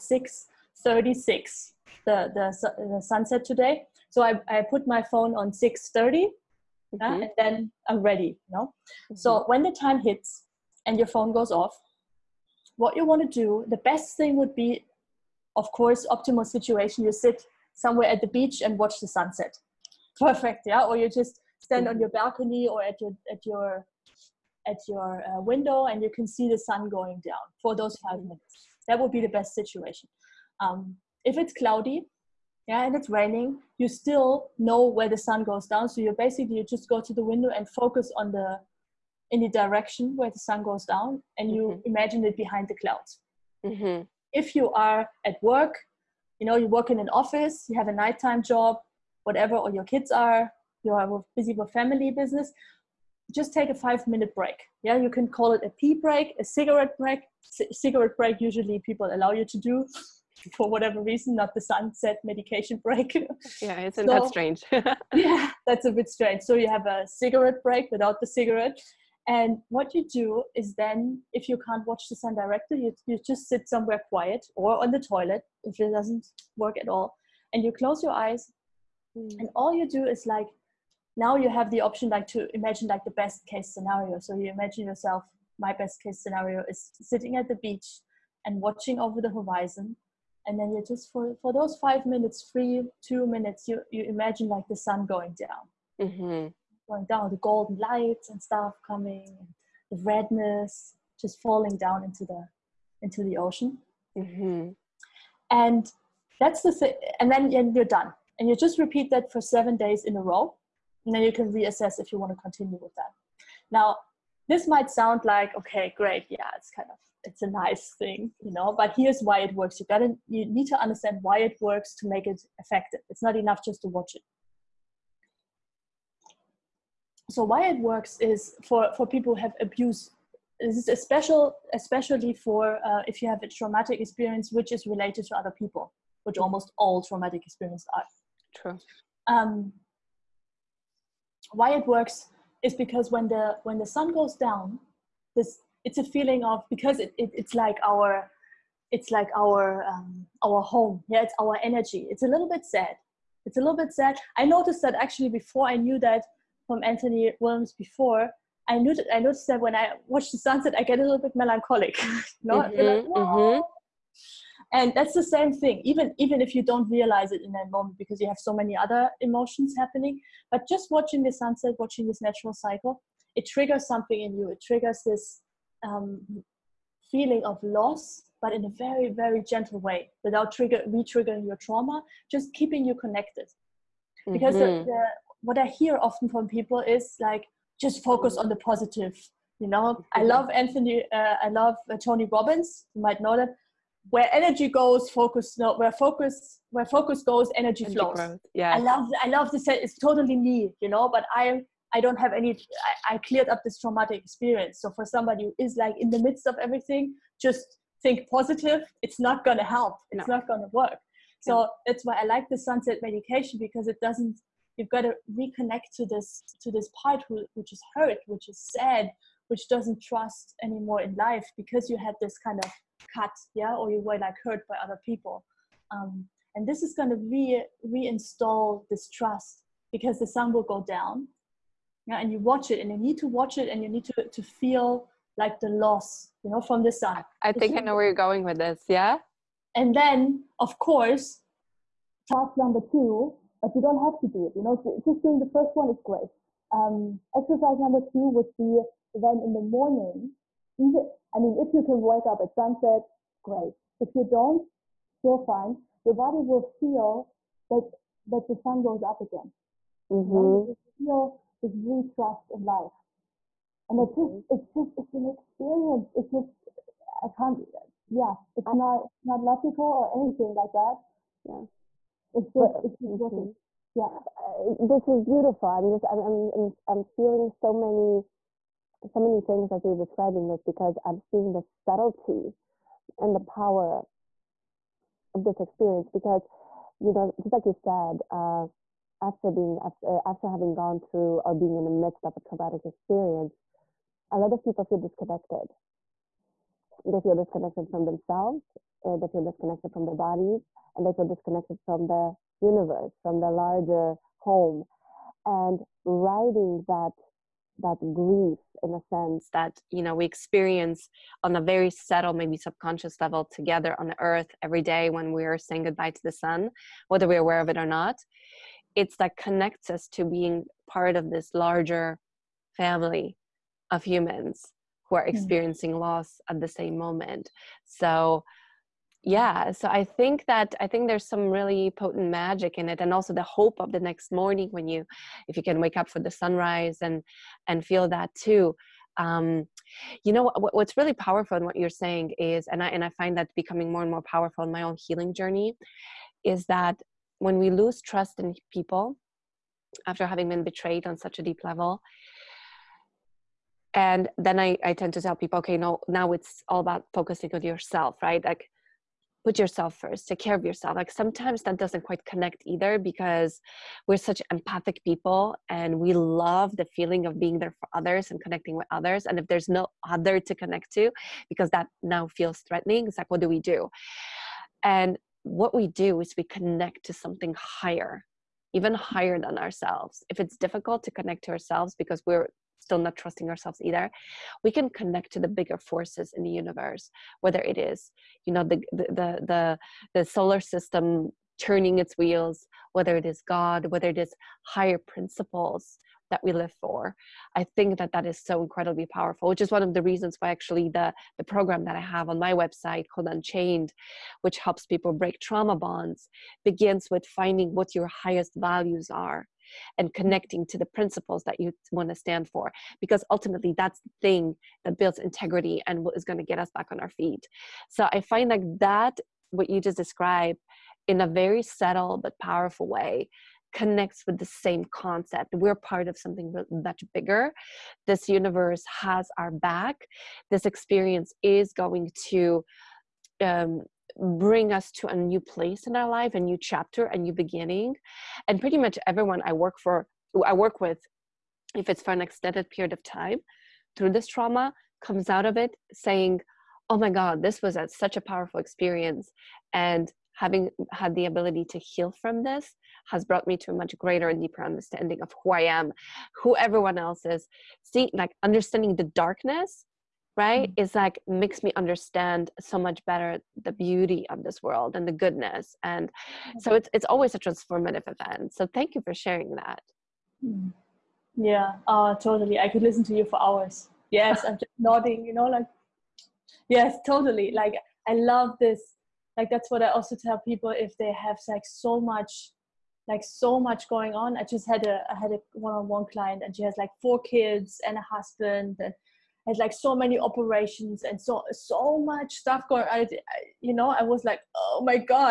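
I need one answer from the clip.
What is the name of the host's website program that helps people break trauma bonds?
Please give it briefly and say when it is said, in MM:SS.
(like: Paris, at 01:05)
Unchained, at 06:43.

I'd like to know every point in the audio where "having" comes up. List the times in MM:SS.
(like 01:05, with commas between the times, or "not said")
04:50, 05:50, 07:30.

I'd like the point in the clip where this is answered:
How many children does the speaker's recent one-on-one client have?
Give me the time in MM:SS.
08:07.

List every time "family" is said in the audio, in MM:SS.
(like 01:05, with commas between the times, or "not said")
00:51, 05:22.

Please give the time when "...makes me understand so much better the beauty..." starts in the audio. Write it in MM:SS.
07:41.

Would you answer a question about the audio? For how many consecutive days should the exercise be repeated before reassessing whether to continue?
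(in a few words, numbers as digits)
7.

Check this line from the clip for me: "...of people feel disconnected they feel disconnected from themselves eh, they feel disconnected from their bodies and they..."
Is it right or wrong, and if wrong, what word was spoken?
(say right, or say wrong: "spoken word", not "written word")
right.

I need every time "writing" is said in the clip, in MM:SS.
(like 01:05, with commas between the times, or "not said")
05:06.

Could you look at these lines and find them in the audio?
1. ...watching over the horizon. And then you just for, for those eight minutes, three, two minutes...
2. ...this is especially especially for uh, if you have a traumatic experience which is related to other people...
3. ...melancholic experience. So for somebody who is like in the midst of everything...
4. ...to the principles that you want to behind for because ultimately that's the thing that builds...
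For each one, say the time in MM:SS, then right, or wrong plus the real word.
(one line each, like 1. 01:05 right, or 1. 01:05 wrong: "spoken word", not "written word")
1. 01:28 wrong: "five", not "eight"
2. 02:10 right
3. 03:23 wrong: "traumatic", not "melancholic"
4. 06:50 wrong: "stand", not "behind".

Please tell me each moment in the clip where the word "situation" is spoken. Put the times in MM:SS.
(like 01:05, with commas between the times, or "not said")
00:16, 00:29.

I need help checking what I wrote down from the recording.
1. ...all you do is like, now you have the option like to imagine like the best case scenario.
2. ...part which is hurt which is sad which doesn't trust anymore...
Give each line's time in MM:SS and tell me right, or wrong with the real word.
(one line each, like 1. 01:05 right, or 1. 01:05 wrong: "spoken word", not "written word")
1. 01:19 right
2. 03:37 right.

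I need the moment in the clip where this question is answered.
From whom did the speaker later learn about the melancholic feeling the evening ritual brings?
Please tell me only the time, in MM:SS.
02:36.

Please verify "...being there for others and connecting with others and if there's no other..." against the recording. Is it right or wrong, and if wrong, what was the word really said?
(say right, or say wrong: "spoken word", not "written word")
right.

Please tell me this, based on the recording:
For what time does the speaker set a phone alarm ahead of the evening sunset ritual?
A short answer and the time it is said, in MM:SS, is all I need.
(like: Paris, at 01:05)
6:30, at 00:05.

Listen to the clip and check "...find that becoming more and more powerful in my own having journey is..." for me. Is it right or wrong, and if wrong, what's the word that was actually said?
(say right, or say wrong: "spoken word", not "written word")
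wrong: "healing", not "having".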